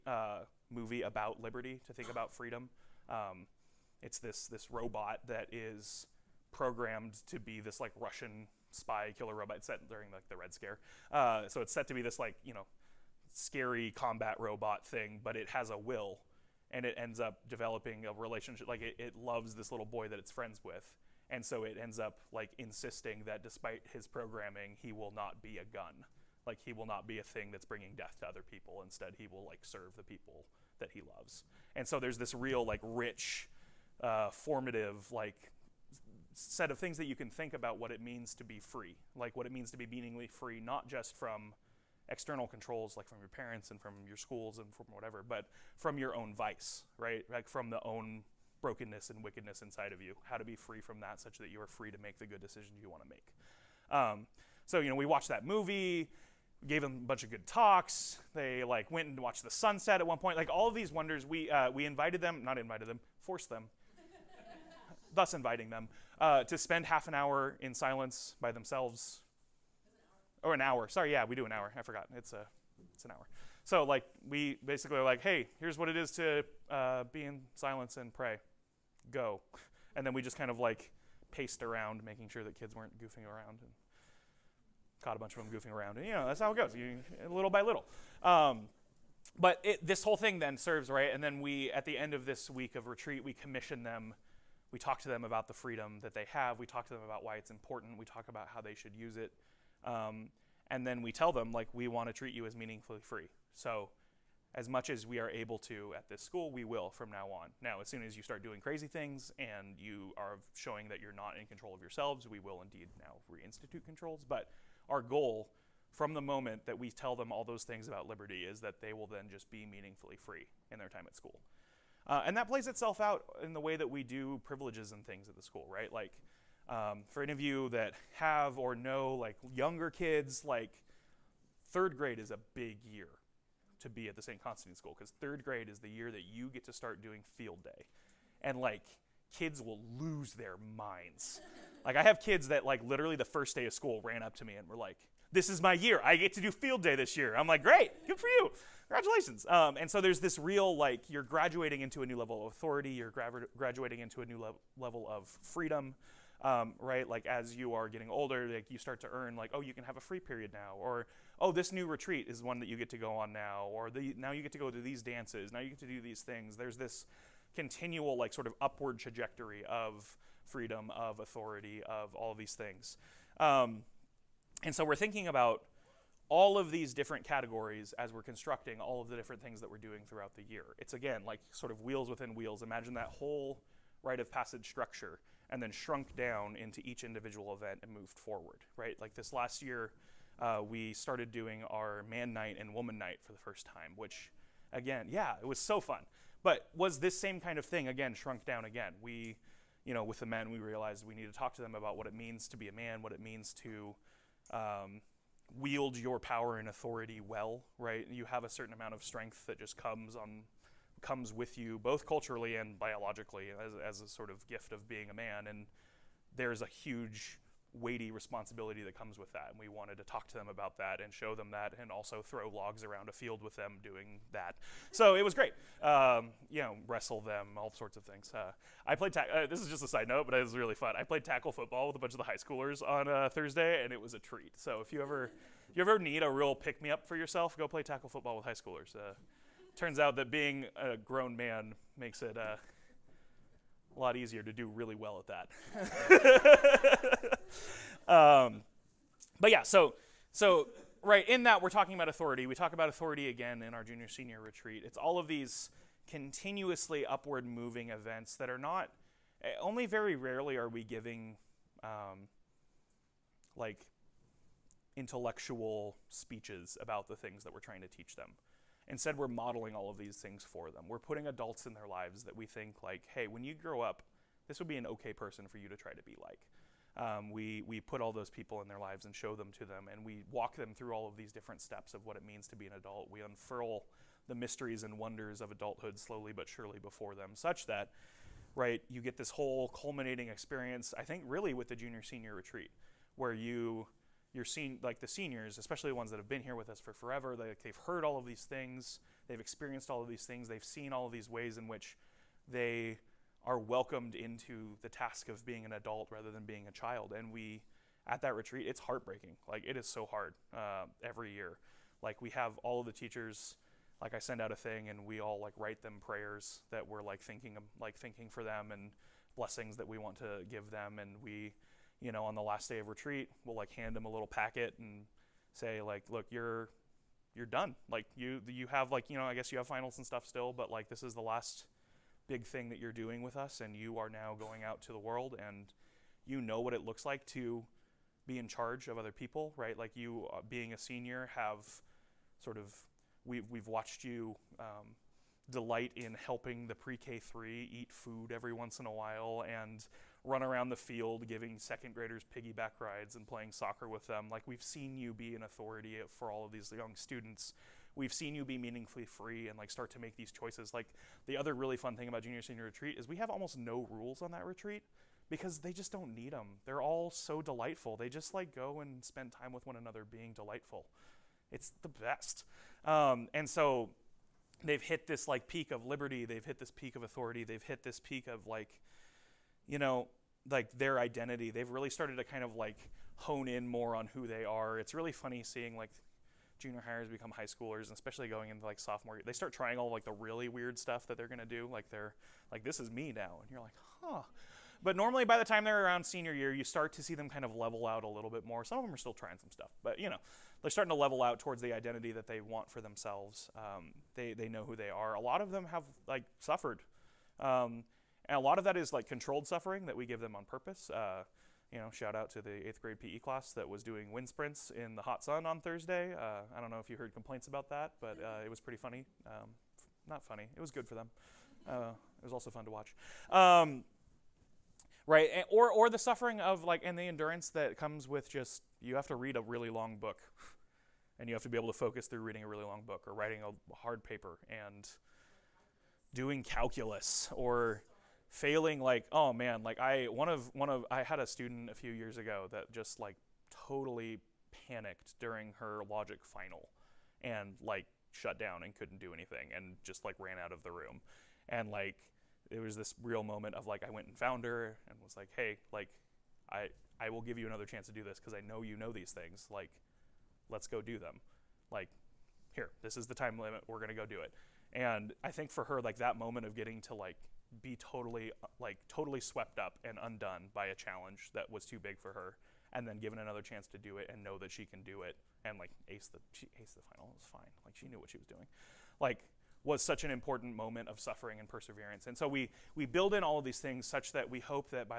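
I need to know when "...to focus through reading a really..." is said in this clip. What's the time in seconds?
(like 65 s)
431 s.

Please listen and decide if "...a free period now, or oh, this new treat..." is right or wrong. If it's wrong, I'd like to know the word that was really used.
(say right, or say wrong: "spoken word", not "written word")
wrong: "retreat", not "treat".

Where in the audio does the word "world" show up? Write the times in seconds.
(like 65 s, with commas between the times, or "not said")
334 s.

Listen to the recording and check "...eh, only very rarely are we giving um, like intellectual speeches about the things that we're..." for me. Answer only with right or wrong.
right.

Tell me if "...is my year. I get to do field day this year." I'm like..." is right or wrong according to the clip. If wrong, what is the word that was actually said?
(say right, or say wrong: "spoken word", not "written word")
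right.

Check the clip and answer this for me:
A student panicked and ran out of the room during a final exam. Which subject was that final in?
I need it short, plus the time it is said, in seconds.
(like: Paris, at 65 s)
logic, at 445 s.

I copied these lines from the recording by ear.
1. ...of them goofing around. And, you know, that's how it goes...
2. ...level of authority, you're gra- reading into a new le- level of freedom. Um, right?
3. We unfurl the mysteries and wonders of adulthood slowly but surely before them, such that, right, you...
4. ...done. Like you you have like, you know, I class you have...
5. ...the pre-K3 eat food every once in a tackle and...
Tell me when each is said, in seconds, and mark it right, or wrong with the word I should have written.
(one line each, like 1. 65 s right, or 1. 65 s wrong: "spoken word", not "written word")
1. 85 s right
2. 152 s wrong: "graduating", not "reading"
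3. 283 s right
4. 327 s wrong: "guess", not "class"
5. 346 s wrong: "while", not "tackle".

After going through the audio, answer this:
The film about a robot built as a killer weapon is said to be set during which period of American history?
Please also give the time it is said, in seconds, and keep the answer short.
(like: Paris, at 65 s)
Red Scare, at 10 s.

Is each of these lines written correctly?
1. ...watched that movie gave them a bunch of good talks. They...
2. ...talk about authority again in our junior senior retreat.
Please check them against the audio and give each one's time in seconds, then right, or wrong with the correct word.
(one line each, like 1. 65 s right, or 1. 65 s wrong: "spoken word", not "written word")
1. 55 s right
2. 252 s right.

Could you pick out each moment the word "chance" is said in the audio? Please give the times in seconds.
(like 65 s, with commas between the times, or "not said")
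457 s, 473 s.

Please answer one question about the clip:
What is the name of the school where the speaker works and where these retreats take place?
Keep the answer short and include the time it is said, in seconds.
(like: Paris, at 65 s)
St. Constantine School, at 134 s.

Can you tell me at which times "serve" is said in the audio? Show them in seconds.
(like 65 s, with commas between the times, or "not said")
29 s, 90 s.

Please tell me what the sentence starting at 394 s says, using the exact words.
But normally by the time they're around senior year, you start to see them kind of level out a little bit more.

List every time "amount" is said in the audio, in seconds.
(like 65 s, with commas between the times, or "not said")
208 s.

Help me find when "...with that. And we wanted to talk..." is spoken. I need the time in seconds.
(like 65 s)
219 s.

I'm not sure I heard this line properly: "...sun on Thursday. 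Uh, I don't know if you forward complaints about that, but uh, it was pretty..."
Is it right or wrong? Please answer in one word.
wrong.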